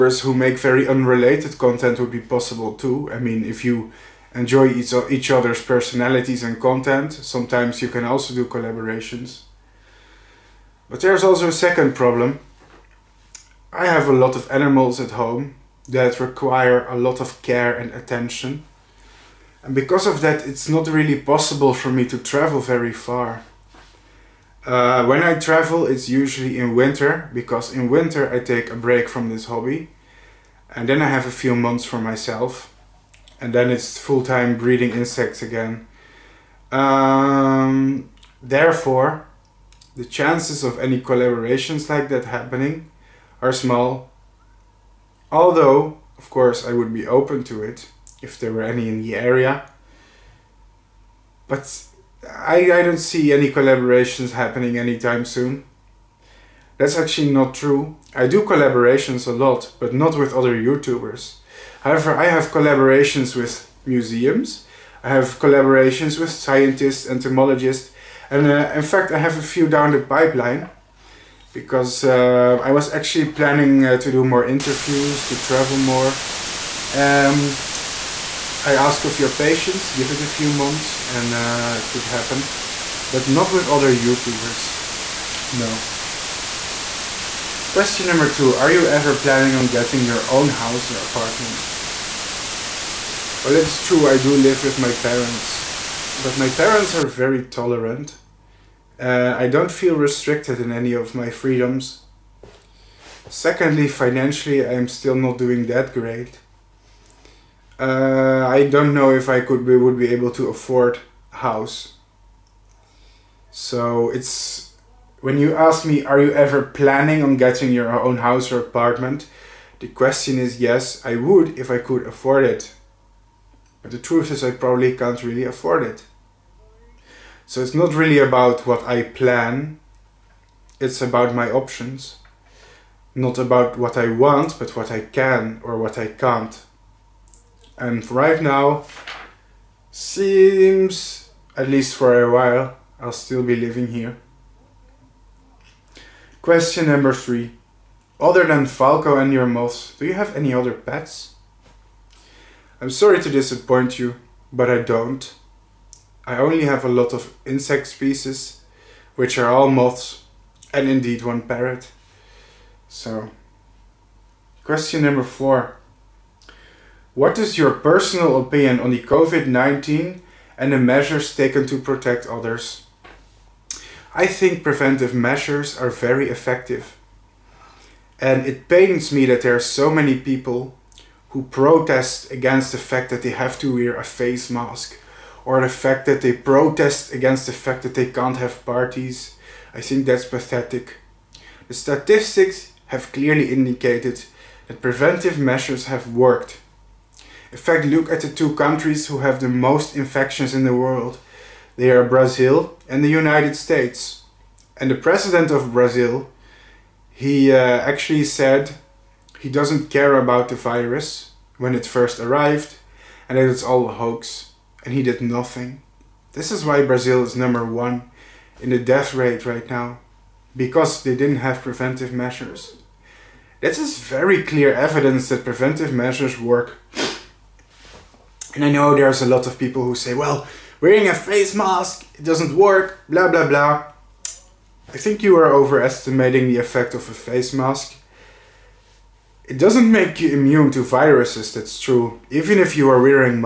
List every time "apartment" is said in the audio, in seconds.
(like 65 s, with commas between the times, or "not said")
91 s, 118 s.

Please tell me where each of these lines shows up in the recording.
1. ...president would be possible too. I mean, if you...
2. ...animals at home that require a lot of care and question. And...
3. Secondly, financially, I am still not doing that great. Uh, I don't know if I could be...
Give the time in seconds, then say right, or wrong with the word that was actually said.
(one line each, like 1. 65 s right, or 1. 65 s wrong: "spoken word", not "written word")
1. 1 s wrong: "content", not "president"
2. 14 s wrong: "attention", not "question"
3. 103 s right.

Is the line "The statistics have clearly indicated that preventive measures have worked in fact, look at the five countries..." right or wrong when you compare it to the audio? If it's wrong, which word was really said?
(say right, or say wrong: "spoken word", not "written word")
wrong: "two", not "five".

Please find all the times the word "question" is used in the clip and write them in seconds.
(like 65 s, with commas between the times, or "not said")
87 s, 119 s, 146 s, 164 s.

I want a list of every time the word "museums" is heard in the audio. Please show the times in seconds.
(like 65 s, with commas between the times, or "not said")
63 s.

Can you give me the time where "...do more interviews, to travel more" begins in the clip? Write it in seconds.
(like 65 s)
74 s.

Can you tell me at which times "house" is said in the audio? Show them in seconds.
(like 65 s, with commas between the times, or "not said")
90 s, 111 s, 118 s.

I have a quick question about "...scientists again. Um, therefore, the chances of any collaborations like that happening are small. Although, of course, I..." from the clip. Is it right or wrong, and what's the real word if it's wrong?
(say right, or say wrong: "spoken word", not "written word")
wrong: "insects", not "scientists".